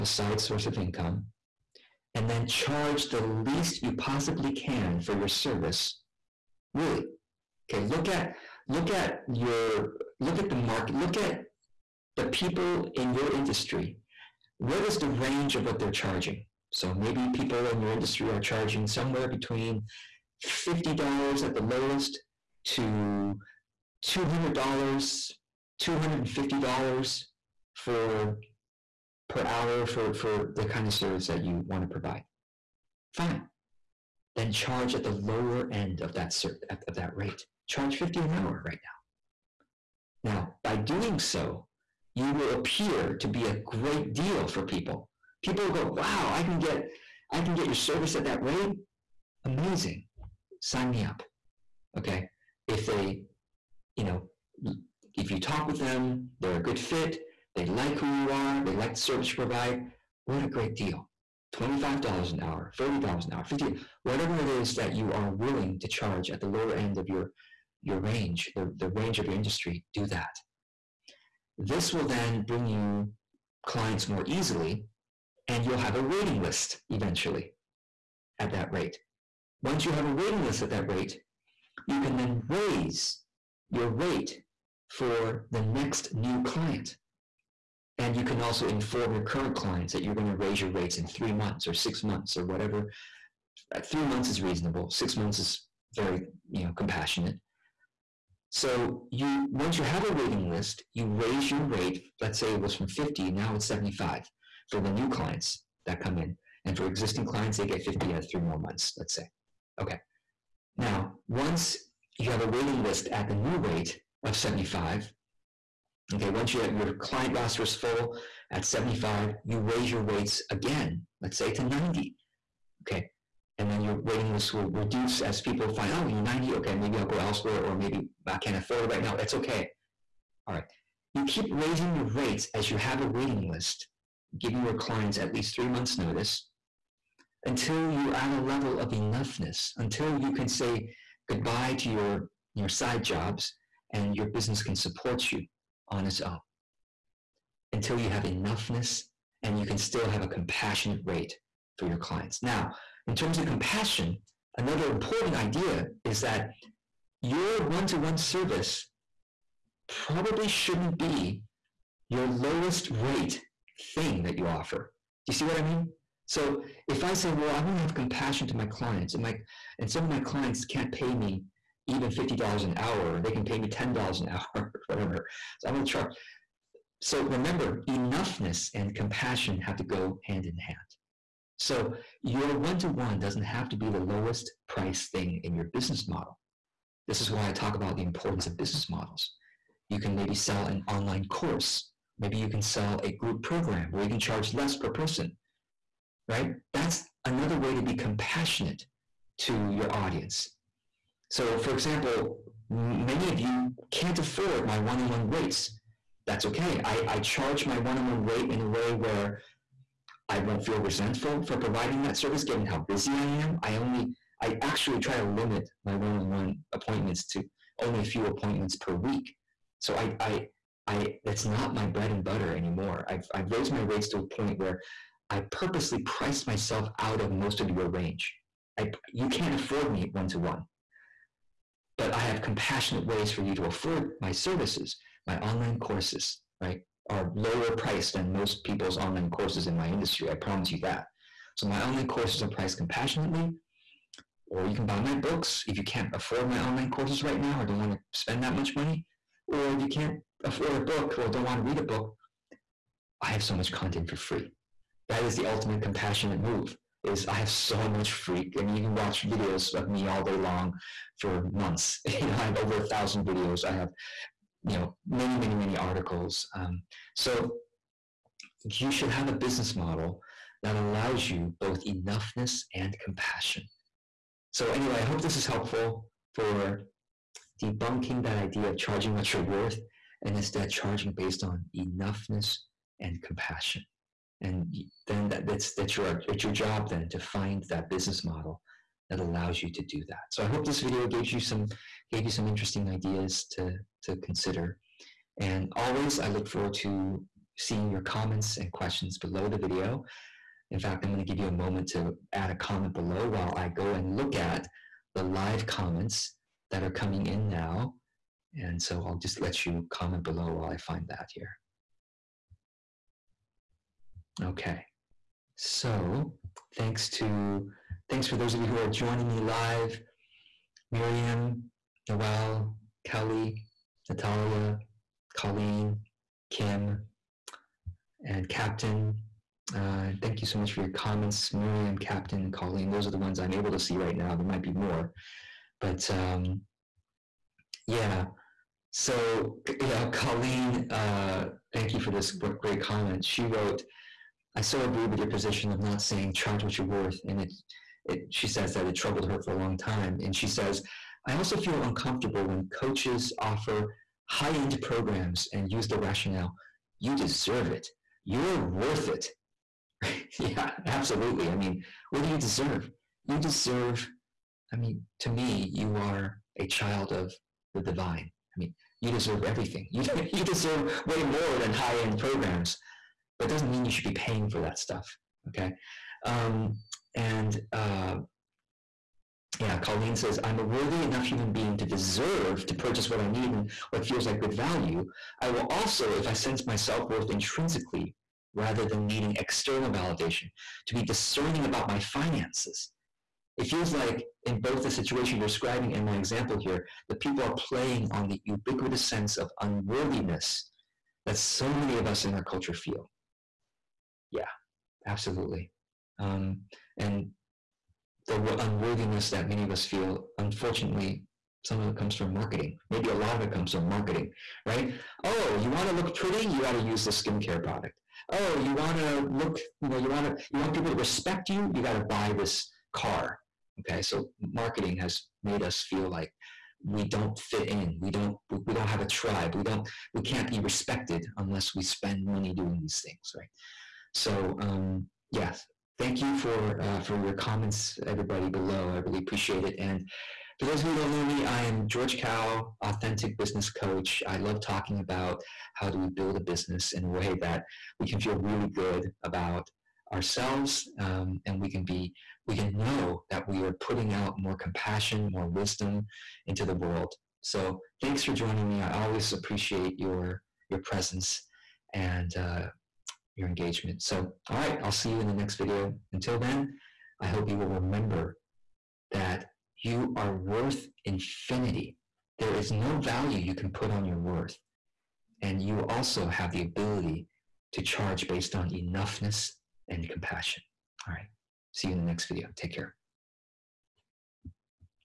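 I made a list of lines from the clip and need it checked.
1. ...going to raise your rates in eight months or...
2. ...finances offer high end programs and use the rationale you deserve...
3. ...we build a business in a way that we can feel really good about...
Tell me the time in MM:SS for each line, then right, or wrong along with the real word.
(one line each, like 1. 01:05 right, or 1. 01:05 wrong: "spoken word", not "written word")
1. 01:30 wrong: "three", not "eight"
2. 05:52 wrong: "coaches", not "finances"
3. 07:25 right.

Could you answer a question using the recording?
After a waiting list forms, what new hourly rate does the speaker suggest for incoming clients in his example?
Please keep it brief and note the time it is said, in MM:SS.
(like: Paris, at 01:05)
$75, at 01:43.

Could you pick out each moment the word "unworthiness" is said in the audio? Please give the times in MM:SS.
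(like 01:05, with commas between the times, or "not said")
06:39, 06:48.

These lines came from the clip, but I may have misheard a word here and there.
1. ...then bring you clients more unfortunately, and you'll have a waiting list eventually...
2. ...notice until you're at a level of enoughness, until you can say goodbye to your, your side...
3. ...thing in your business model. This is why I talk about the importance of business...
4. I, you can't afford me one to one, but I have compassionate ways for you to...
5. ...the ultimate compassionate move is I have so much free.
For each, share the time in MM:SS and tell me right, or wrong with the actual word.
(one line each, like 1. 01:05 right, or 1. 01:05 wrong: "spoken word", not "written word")
1. 01:12 wrong: "easily", not "unfortunately"
2. 02:15 right
3. 03:05 right
4. 03:48 right
5. 04:15 right.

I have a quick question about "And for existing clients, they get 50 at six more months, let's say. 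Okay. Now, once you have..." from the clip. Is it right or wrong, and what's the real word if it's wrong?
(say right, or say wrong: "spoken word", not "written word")
wrong: "three", not "six".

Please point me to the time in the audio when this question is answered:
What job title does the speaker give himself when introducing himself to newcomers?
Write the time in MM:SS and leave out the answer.
07:22.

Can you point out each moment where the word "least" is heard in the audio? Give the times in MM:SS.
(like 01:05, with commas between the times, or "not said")
00:03, 02:15.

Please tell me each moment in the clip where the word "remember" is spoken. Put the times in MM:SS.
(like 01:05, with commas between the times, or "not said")
02:57, 07:47.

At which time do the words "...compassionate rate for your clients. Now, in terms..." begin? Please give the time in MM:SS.
02:30.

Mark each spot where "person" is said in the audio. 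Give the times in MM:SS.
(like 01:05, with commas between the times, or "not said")
03:14.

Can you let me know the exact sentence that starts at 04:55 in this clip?
And always, I look forward to seeing your comments and questions below the video.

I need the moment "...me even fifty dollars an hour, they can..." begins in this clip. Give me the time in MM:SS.
02:51.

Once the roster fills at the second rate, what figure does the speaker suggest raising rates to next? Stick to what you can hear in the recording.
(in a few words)
$90.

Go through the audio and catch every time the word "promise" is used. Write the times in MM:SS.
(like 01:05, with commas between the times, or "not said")
04:00.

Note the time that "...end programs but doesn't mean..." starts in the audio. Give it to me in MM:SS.
06:11.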